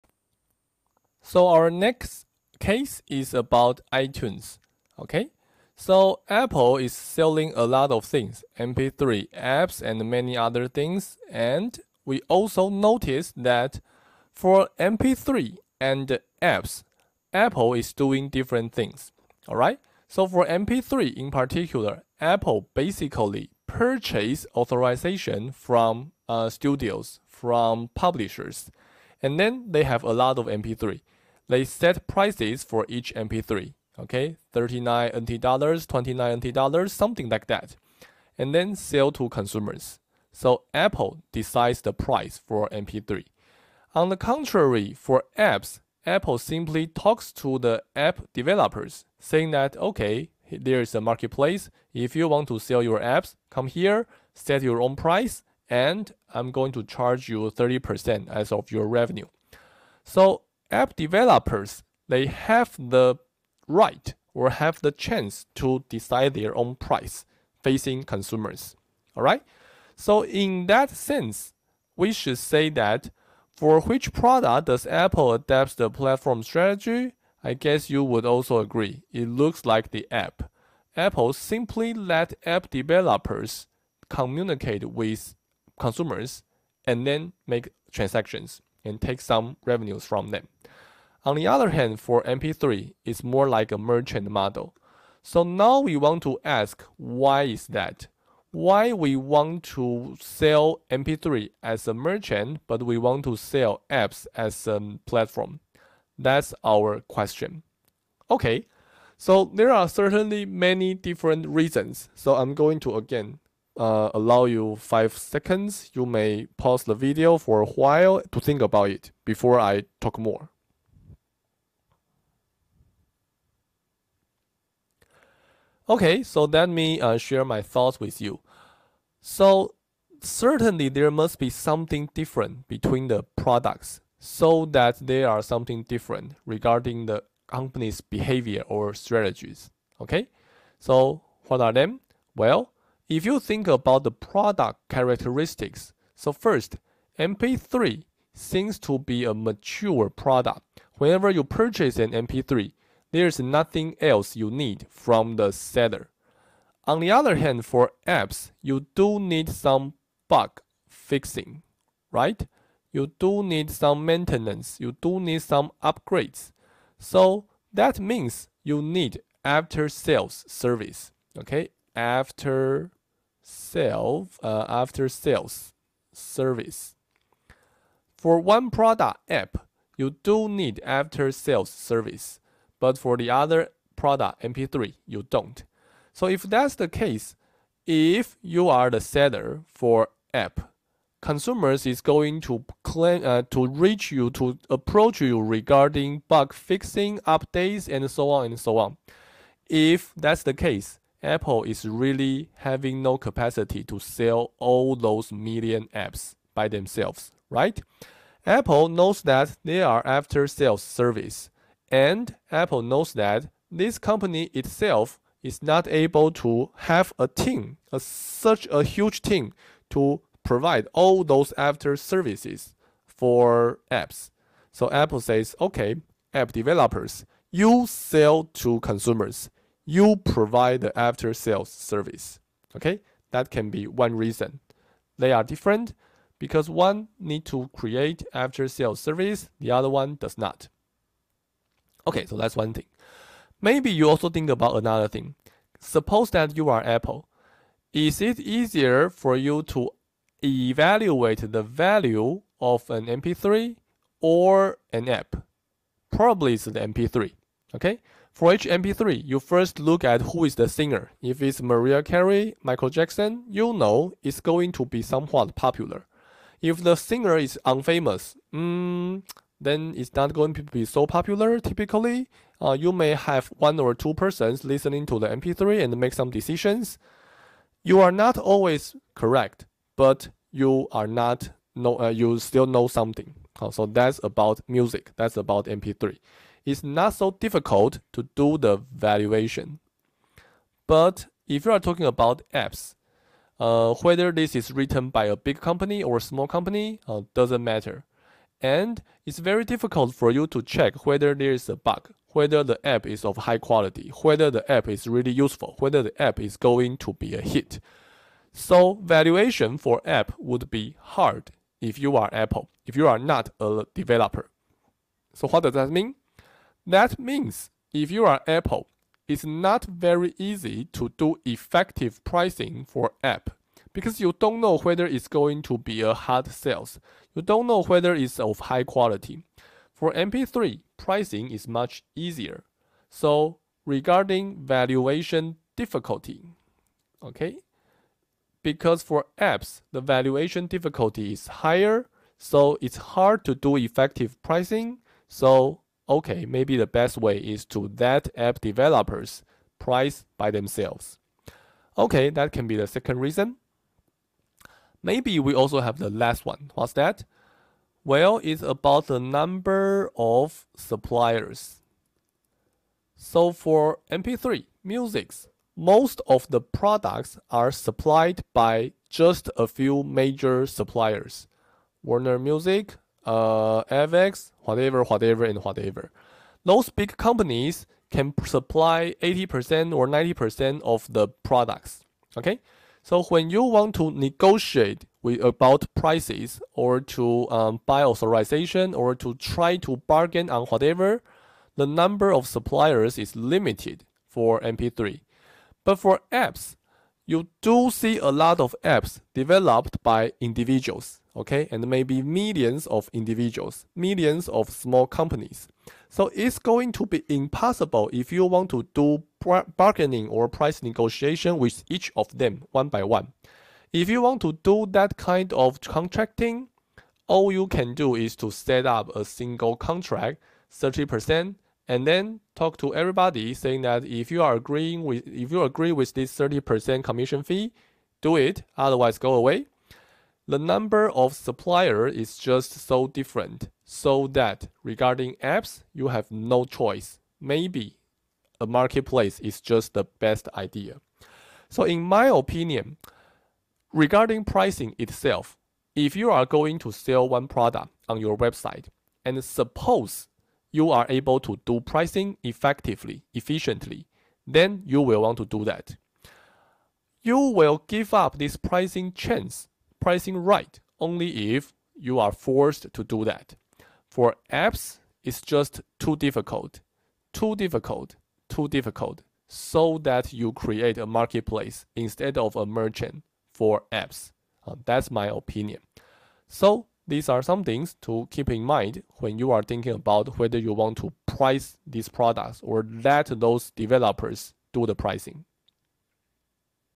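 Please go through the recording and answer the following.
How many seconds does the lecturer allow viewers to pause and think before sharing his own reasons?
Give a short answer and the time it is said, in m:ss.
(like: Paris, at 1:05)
5, at 1:54.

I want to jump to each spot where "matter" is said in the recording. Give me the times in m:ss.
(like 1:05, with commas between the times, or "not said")
4:57.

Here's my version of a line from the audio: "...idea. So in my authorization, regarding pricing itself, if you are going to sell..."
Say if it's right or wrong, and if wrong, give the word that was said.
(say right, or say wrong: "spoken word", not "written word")
wrong: "opinion", not "authorization".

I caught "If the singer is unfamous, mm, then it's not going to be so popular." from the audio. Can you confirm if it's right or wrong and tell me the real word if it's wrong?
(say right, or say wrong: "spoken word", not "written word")
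right.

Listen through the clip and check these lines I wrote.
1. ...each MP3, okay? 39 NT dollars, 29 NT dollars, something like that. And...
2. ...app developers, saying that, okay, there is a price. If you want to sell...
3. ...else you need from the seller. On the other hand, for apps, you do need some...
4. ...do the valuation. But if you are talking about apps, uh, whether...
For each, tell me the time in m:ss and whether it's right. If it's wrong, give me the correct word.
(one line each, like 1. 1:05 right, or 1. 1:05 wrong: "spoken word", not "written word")
1. 0:32 right
2. 0:47 wrong: "marketplace", not "price"
3. 2:33 right
4. 4:48 right.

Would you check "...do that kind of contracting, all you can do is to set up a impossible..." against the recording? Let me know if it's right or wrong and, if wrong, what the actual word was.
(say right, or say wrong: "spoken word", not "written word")
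wrong: "single", not "impossible".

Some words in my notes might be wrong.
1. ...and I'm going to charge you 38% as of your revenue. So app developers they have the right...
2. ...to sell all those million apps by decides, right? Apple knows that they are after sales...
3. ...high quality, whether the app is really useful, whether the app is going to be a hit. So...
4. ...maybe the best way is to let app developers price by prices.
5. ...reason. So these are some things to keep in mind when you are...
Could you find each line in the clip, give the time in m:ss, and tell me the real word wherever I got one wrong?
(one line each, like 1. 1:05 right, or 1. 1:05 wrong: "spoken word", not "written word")
1. 0:55 wrong: "30", not "38"
2. 3:23 wrong: "themselves", not "decides"
3. 5:03 right
4. 5:46 wrong: "themselves", not "prices"
5. 7:55 wrong: "opinion", not "reason".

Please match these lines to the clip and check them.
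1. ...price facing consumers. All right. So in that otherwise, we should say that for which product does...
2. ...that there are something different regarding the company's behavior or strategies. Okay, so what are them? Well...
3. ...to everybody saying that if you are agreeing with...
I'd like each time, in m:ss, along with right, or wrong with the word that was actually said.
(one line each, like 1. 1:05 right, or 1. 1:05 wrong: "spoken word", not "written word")
1. 1:06 wrong: "sense", not "otherwise"
2. 2:14 right
3. 7:02 right.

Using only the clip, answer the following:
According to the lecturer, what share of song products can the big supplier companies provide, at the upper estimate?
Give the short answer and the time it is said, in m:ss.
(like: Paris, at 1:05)
90%, at 6:20.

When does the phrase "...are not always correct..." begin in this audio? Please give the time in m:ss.
4:38.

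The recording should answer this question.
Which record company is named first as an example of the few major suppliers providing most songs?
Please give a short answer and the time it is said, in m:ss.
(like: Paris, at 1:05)
Warner Music, at 6:12.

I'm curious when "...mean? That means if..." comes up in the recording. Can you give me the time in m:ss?
5:15.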